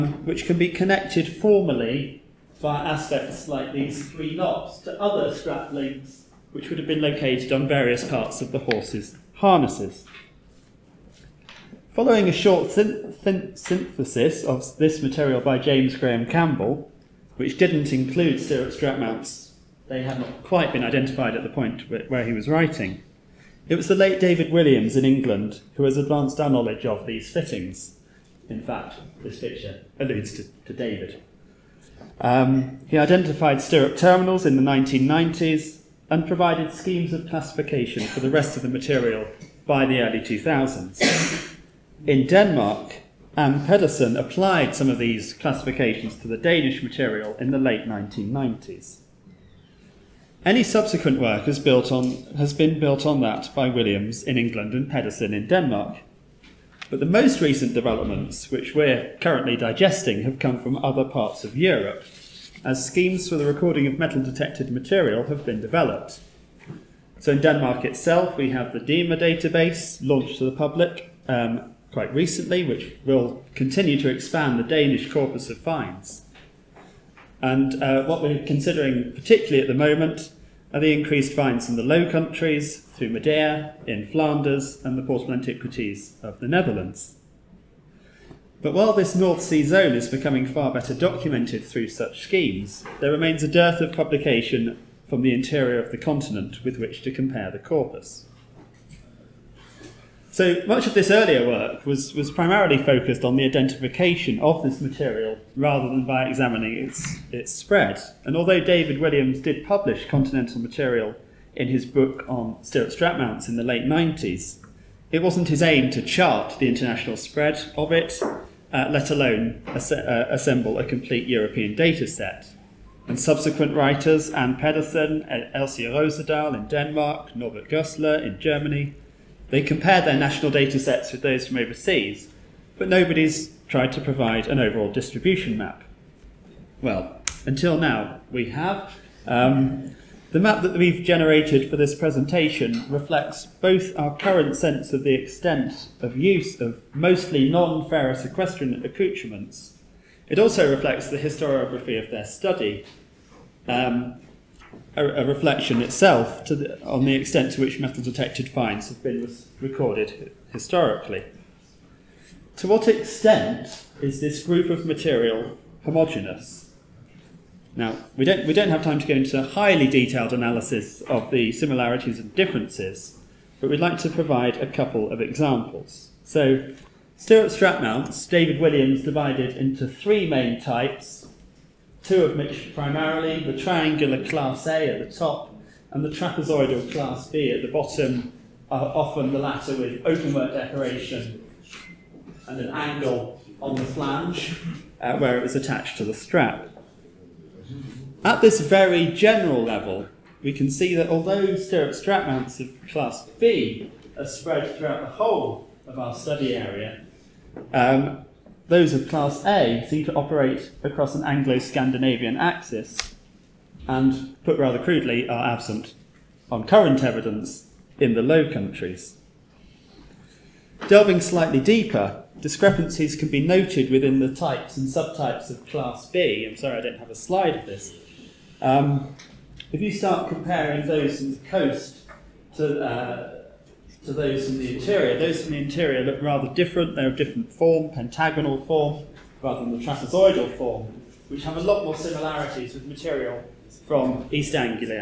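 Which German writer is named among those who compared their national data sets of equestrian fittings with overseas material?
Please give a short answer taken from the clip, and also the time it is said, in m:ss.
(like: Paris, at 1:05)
Norbert Goßler, at 2:07.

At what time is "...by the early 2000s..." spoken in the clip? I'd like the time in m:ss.
0:39.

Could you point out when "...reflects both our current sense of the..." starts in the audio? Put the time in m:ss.
2:22.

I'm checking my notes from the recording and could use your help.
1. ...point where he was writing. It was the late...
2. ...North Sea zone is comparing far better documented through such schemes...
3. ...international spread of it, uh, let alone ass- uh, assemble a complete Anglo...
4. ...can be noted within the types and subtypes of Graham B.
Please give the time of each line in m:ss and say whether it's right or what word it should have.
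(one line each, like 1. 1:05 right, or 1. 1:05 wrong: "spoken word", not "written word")
1. 0:21 right
2. 1:29 wrong: "becoming", not "comparing"
3. 1:56 wrong: "European", not "Anglo"
4. 3:43 wrong: "Class", not "Graham".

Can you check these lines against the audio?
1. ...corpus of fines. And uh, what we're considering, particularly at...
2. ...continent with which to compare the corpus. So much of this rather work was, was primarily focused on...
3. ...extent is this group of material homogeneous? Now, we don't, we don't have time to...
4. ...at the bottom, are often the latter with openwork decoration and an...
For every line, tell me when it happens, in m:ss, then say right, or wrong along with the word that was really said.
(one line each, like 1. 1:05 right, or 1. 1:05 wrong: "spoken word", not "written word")
1. 1:15 right
2. 1:35 wrong: "earlier", not "rather"
3. 2:42 right
4. 3:07 right.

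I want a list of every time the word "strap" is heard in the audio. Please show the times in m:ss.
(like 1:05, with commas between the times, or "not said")
0:05, 0:18, 1:52, 2:57, 3:16, 3:21.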